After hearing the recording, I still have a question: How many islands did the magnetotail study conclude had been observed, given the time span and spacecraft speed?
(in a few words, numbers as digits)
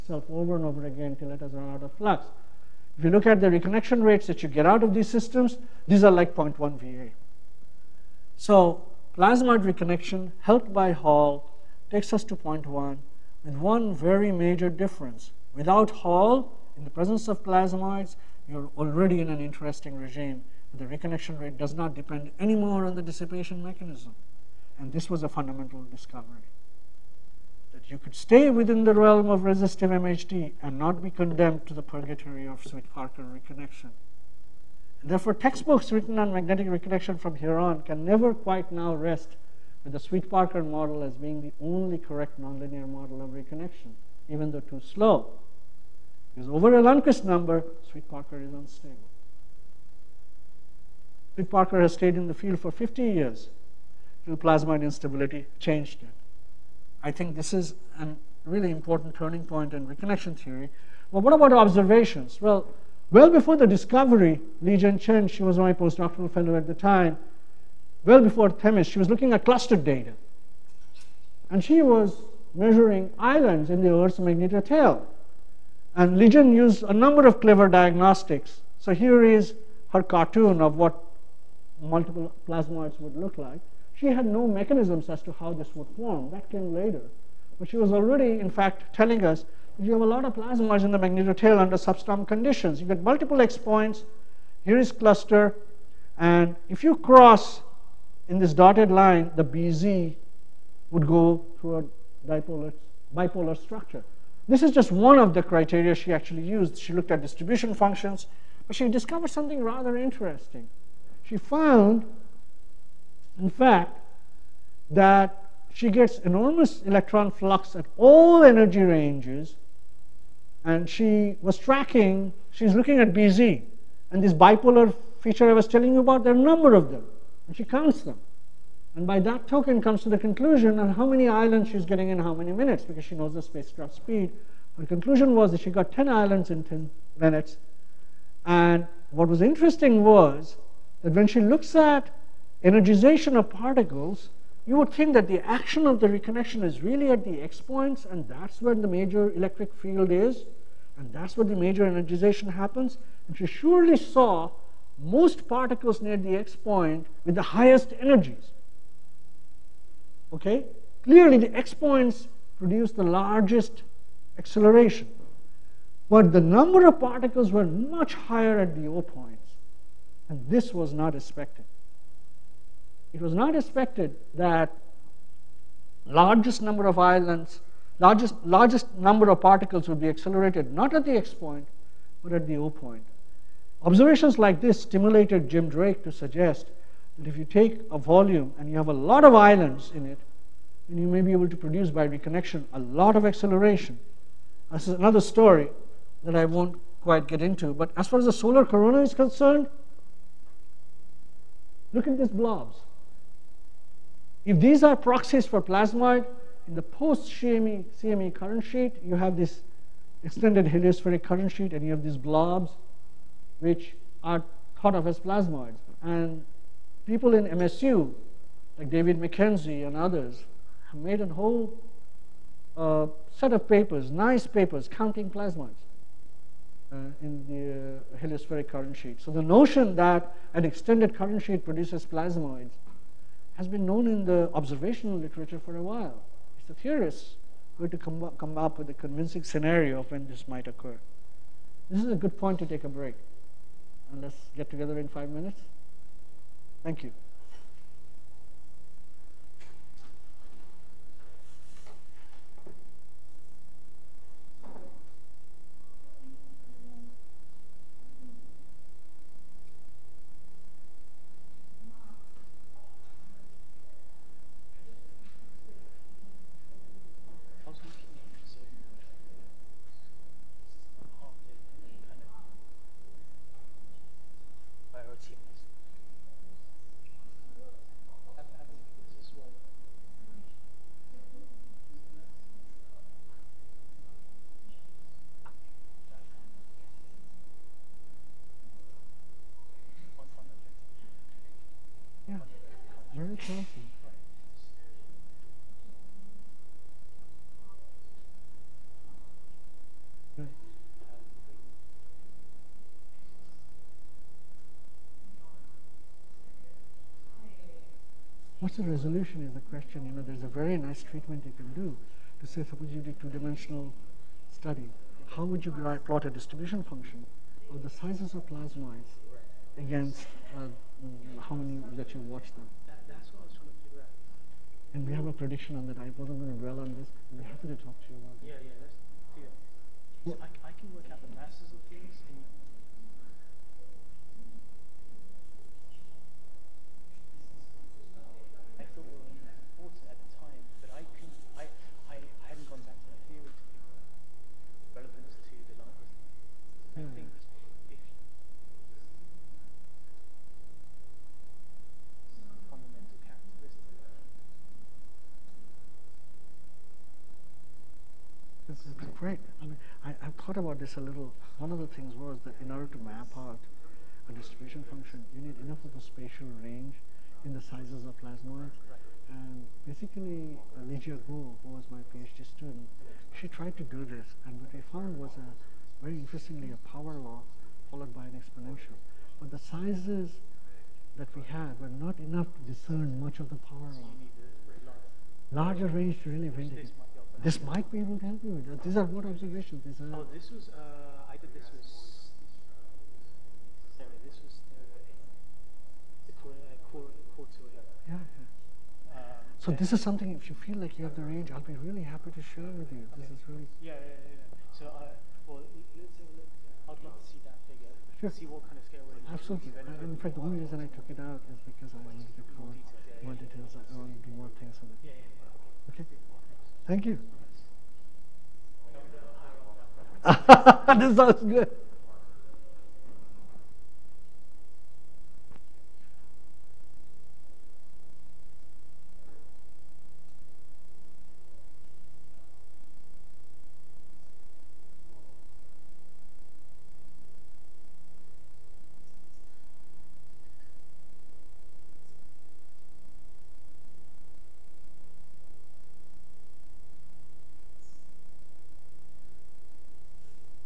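10 islands in 10 minutes.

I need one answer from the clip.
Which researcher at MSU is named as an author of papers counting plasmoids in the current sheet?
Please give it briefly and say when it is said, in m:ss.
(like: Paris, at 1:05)
David McKenzie, at 3:38.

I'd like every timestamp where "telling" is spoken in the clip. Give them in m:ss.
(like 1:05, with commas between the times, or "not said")
1:28, 2:05.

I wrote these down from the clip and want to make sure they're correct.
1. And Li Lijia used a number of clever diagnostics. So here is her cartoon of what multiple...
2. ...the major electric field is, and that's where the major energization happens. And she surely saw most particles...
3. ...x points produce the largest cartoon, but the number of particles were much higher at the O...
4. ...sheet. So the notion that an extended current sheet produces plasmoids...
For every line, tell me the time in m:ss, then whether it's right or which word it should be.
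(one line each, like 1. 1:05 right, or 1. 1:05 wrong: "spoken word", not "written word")
1. 1:15 wrong: "Legion", not "Lijia"
2. 2:28 right
3. 2:41 wrong: "acceleration", not "cartoon"
4. 3:48 right.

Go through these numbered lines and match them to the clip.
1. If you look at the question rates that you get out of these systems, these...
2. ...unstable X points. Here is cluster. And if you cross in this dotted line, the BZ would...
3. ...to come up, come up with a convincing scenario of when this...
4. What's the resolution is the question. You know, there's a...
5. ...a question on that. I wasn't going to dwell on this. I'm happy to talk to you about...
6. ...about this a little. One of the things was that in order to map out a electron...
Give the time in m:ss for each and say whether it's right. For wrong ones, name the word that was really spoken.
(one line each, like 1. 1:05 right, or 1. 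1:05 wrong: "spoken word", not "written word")
1. 0:02 wrong: "reconnection", not "question"
2. 1:33 wrong: "multiple", not "unstable"
3. 3:57 right
4. 5:08 right
5. 5:25 wrong: "prediction", not "question"
6. 6:00 wrong: "distribution", not "electron".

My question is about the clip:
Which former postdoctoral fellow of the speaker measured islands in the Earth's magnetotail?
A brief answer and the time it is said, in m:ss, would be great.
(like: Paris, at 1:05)
Li Jen Chen, at 1:04.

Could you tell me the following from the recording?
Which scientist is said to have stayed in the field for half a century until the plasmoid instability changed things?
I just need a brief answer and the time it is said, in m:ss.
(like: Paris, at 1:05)
Rick Parker, at 0:51.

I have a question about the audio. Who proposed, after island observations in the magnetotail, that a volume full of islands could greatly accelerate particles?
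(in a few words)
Jim Drake.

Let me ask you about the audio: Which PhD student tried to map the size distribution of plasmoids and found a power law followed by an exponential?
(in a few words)
Lijia Guo.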